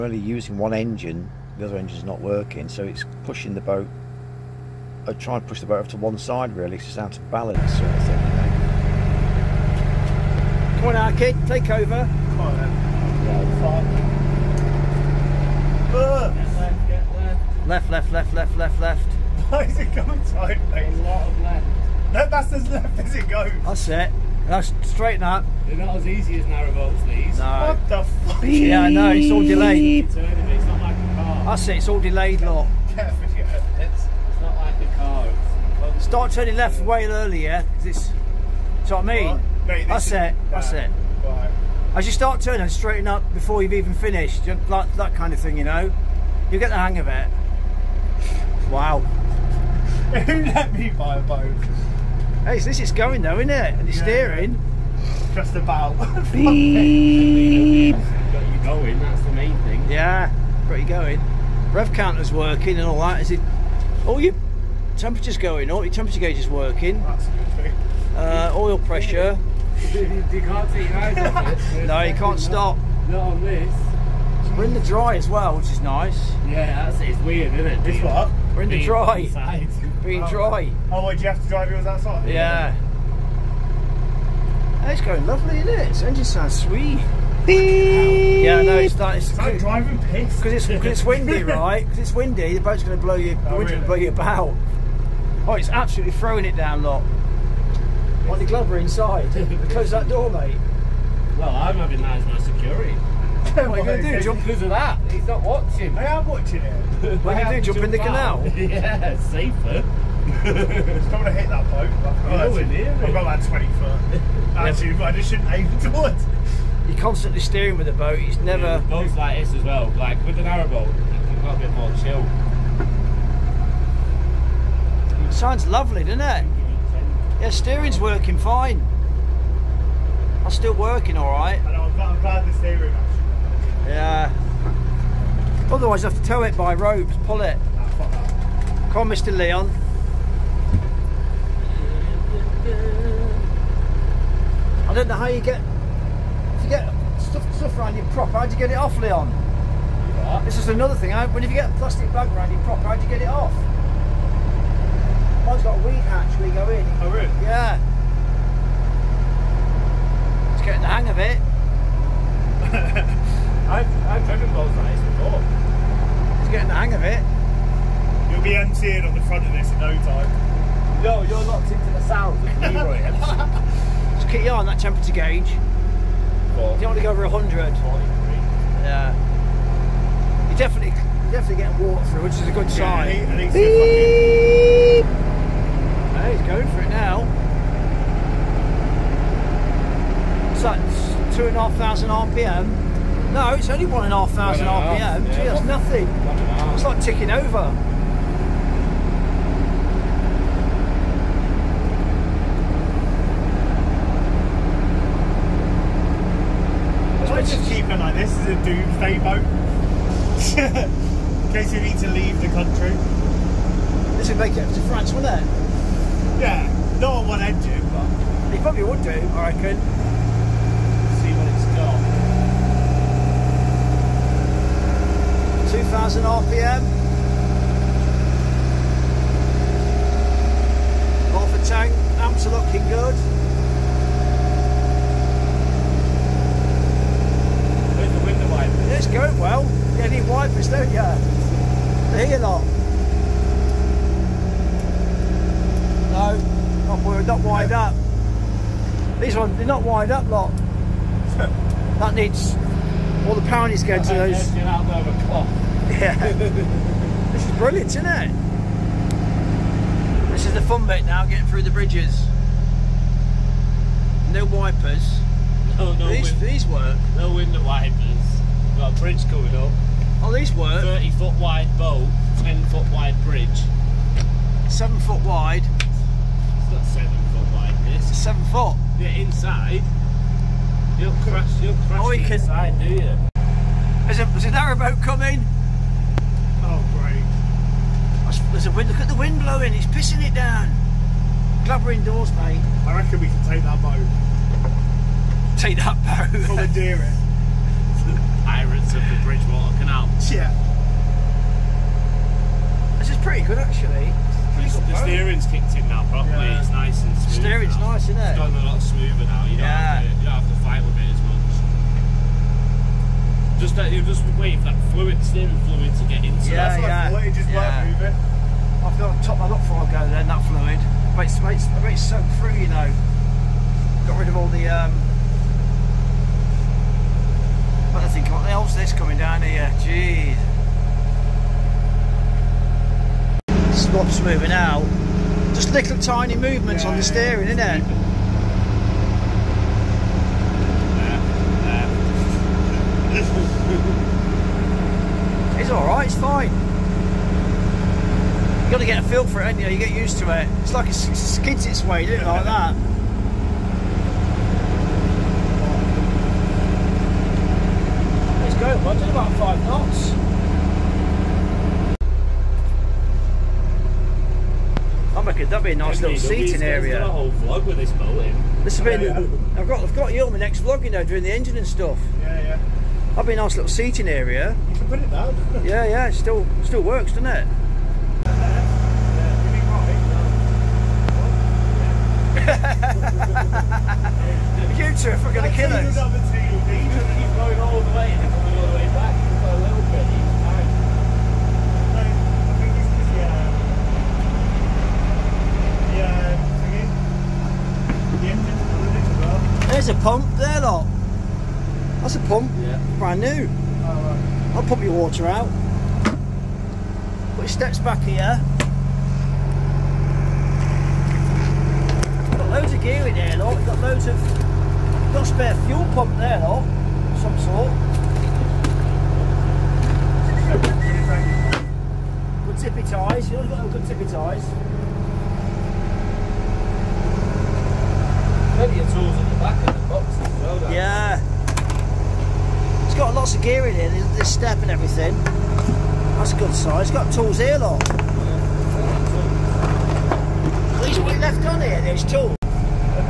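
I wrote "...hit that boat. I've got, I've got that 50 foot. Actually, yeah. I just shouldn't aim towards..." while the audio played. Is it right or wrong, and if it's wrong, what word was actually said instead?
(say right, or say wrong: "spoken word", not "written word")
wrong: "20", not "50".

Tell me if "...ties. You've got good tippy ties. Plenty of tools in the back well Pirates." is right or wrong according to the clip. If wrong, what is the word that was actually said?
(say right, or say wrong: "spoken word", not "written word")
wrong: "Yeah", not "Pirates".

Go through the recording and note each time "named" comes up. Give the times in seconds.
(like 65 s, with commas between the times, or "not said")
not said.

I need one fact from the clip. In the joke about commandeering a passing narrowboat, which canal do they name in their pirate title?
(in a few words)
Bridgewater Canal.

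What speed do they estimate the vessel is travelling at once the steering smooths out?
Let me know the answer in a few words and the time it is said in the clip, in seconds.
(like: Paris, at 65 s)
5 knots, at 359 s.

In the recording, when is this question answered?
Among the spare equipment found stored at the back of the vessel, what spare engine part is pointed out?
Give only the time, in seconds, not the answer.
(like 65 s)
415 s.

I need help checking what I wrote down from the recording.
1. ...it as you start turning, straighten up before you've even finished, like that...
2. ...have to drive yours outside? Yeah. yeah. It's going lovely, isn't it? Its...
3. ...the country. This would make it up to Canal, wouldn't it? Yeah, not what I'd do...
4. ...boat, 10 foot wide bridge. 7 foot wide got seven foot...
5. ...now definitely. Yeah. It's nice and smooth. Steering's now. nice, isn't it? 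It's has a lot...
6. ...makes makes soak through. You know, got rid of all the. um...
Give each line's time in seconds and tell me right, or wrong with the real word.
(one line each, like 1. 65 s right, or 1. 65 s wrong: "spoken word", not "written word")
1. 40 s right
2. 81 s right
3. 212 s wrong: "France", not "Canal"
4. 271 s right
5. 305 s wrong: "properly", not "definitely"
6. 321 s right.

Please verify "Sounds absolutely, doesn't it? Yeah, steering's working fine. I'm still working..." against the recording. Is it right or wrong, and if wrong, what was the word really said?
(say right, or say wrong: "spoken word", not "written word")
wrong: "lovely", not "absolutely".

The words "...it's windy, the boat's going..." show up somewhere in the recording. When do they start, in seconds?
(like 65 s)
91 s.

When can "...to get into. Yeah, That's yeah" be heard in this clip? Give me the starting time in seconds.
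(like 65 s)
315 s.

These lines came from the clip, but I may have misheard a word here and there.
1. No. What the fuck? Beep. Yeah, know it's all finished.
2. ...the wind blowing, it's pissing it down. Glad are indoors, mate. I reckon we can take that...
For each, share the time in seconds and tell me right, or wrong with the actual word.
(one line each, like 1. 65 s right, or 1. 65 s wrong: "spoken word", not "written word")
1. 27 s wrong: "delayed", not "finished"
2. 289 s right.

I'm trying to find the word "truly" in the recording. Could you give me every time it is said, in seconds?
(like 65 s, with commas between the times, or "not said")
not said.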